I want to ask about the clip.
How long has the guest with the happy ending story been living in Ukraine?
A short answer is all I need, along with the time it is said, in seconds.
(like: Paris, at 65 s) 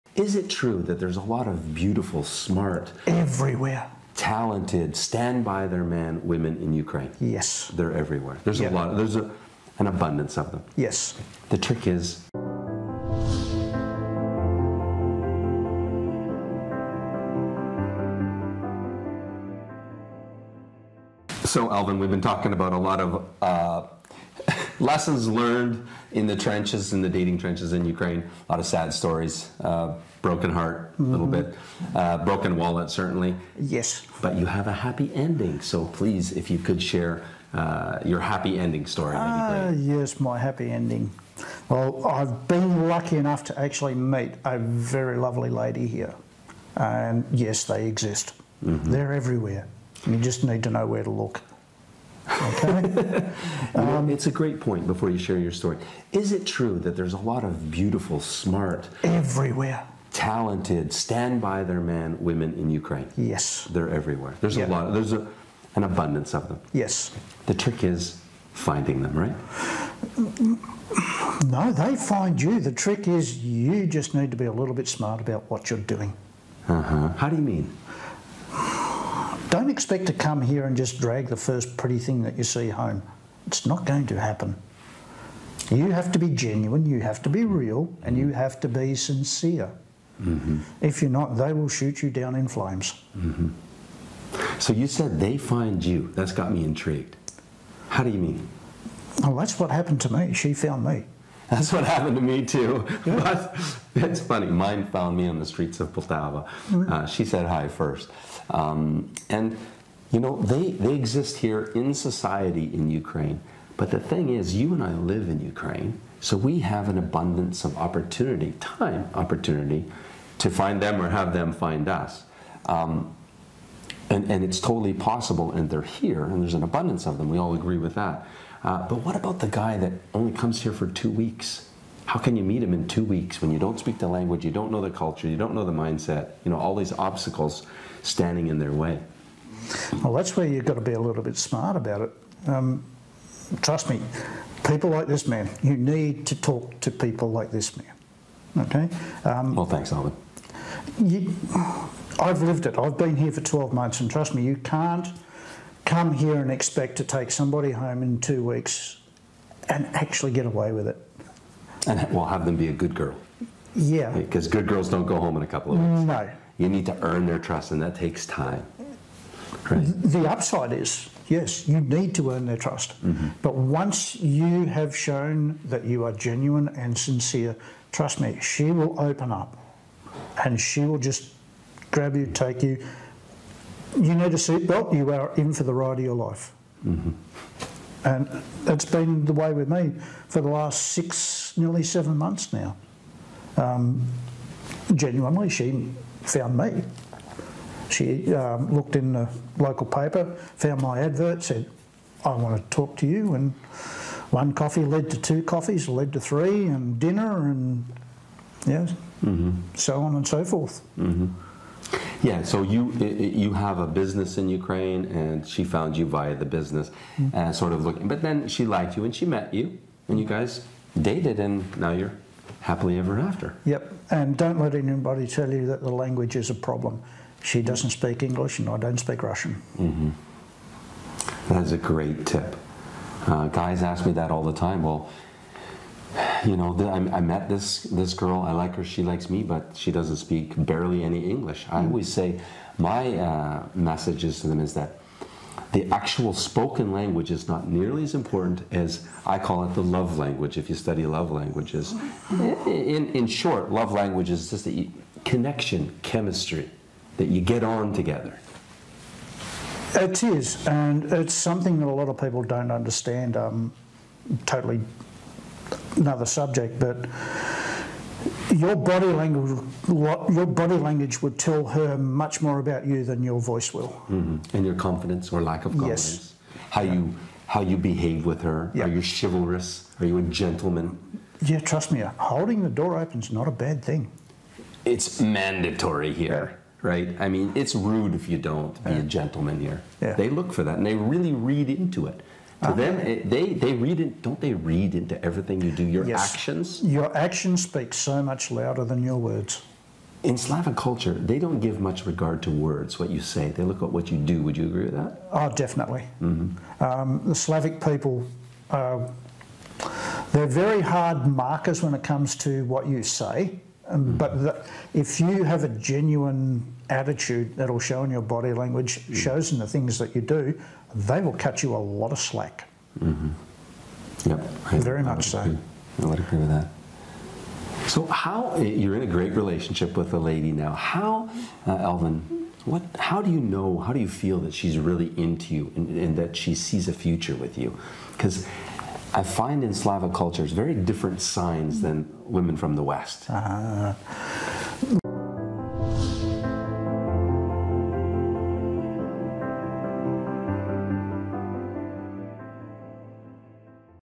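12 months, at 153 s.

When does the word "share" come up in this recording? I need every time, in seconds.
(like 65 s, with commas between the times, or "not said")
36 s, 55 s.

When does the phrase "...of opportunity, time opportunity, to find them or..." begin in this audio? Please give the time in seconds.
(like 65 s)
117 s.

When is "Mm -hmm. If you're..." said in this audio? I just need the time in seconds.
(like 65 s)
90 s.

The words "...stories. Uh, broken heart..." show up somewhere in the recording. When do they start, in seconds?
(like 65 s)
28 s.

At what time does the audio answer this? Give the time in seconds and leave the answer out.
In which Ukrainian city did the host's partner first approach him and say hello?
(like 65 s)
105 s.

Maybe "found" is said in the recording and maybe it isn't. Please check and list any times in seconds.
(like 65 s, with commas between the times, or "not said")
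100 s, 104 s, 196 s, 200 s, 215 s.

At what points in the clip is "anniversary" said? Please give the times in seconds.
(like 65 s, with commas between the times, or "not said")
not said.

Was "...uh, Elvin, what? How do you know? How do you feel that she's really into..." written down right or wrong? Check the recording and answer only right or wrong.
right.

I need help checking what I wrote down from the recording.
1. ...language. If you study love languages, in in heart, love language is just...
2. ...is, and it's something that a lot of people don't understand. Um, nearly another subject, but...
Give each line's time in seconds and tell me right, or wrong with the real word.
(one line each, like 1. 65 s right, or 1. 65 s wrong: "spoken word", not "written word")
1. 250 s wrong: "short", not "heart"
2. 260 s wrong: "totally", not "nearly".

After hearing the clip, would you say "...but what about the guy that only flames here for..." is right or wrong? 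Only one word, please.
wrong.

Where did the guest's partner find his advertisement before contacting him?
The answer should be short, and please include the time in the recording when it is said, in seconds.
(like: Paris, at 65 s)
local paper, at 199 s.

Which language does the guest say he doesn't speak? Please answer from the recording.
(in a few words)
Russian.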